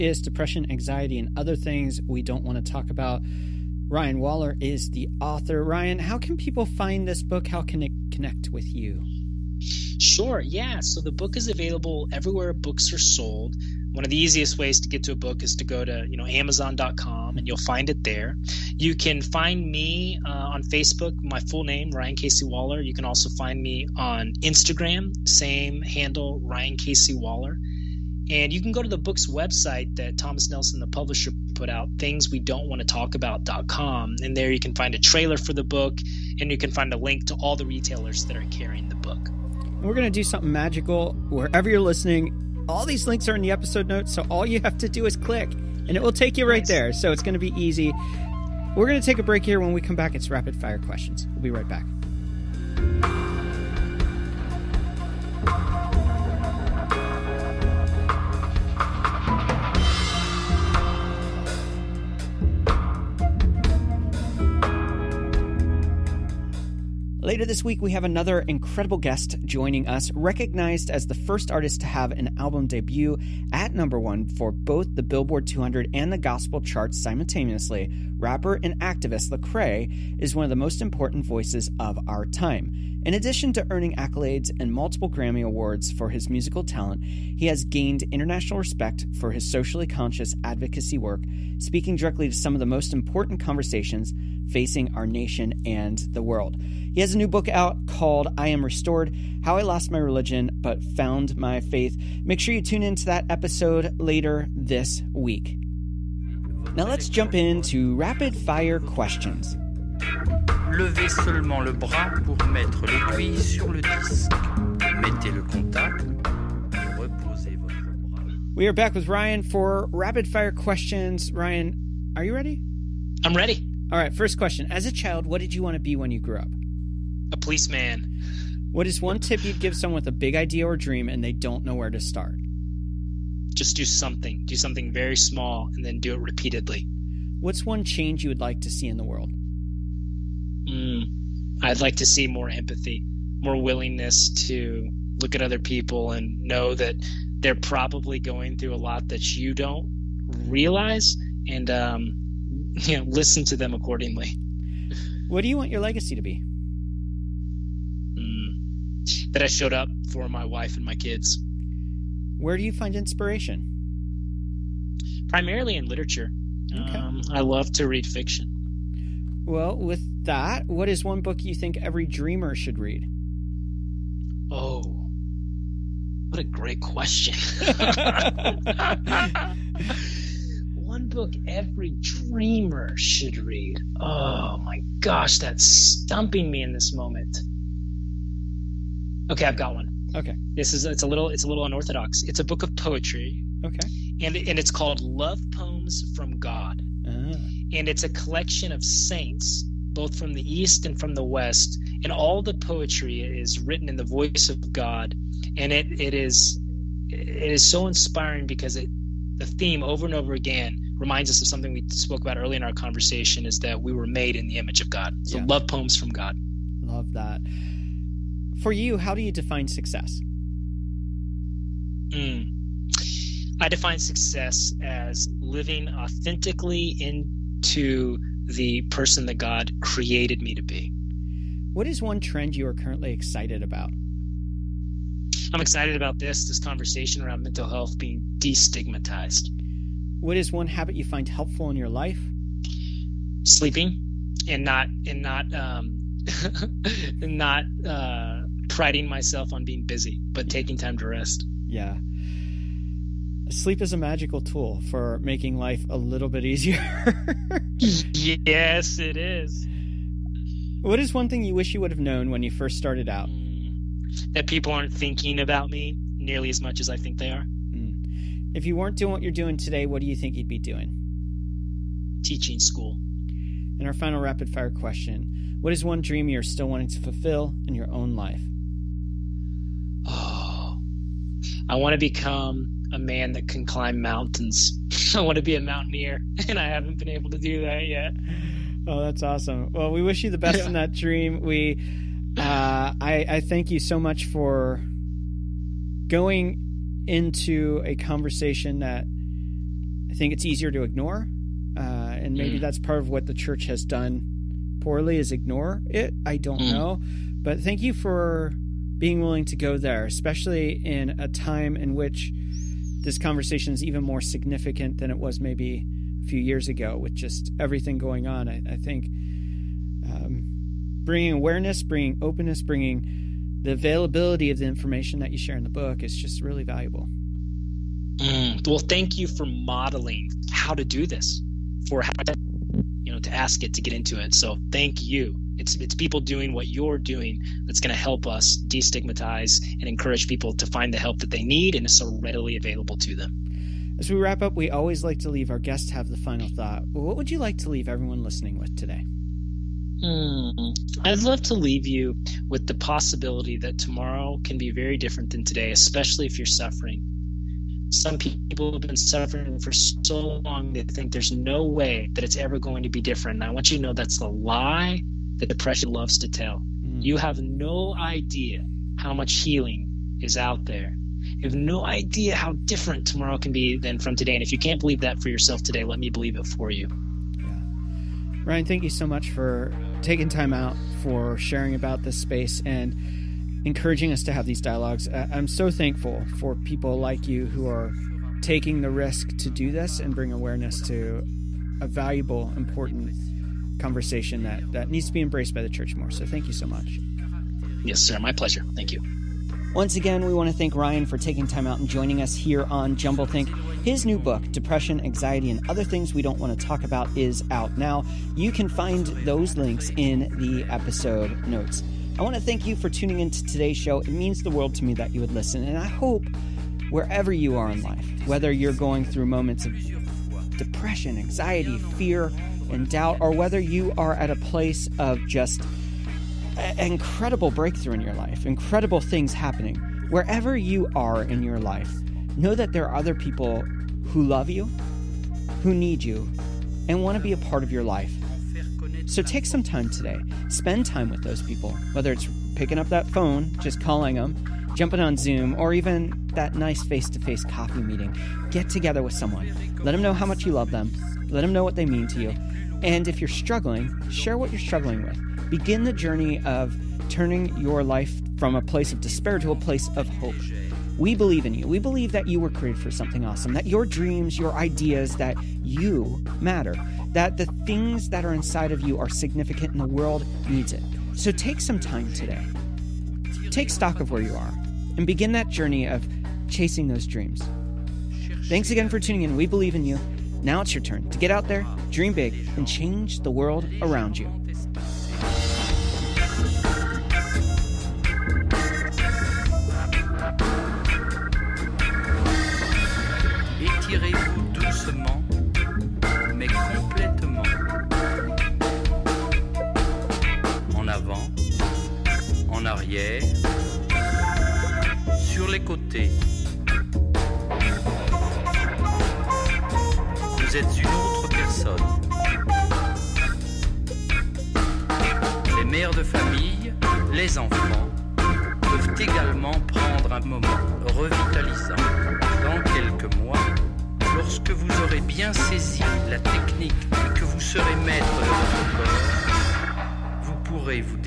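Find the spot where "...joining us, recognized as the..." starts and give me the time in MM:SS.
01:09.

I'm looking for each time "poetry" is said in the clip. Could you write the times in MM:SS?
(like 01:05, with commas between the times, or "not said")
03:12, 03:22.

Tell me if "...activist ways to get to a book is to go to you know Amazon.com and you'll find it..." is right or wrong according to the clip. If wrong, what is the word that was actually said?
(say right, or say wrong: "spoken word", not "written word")
wrong: "easiest", not "activist".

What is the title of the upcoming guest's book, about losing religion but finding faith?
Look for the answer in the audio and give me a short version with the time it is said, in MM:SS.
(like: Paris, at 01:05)
I Am Restored, at 01:38.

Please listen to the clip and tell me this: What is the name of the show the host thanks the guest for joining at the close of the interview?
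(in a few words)
Jumble Think.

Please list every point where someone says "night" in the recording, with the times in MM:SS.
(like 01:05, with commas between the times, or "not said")
not said.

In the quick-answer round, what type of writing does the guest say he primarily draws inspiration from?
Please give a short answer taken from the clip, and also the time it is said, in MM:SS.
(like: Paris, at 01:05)
Literature, at 02:45.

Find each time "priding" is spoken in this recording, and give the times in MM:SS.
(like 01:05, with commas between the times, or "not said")
04:08.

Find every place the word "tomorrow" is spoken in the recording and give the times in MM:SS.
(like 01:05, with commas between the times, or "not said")
05:53, 06:13.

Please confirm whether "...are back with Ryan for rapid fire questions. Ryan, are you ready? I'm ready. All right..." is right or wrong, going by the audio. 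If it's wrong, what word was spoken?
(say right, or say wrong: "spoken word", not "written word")
right.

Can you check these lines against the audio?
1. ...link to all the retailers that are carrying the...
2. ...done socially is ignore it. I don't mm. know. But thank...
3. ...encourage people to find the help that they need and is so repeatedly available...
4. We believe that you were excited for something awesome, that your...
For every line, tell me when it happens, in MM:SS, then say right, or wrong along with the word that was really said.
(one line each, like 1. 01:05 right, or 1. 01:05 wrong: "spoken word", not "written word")
1. 00:36 right
2. 05:03 wrong: "poorly", not "socially"
3. 05:39 wrong: "readily", not "repeatedly"
4. 07:41 wrong: "created", not "excited".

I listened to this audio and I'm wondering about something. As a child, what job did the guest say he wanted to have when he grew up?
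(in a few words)
A policeman.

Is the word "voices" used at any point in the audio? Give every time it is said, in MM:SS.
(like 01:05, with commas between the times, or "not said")
01:21, 03:24.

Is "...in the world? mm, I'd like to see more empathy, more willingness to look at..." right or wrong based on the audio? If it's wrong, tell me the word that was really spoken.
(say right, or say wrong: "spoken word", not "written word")
right.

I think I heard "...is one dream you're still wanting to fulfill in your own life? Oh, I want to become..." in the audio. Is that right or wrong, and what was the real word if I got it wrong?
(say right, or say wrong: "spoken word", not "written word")
right.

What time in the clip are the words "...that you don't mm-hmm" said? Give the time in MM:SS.
02:29.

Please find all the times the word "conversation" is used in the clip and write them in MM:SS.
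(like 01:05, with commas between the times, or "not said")
01:33, 03:32, 03:56, 04:57, 05:13, 06:33.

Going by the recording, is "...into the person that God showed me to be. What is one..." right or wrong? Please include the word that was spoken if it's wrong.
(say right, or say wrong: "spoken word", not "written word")
wrong: "created", not "showed".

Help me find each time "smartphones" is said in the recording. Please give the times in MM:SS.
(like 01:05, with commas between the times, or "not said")
not said.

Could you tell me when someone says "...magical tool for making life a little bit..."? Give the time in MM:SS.
04:13.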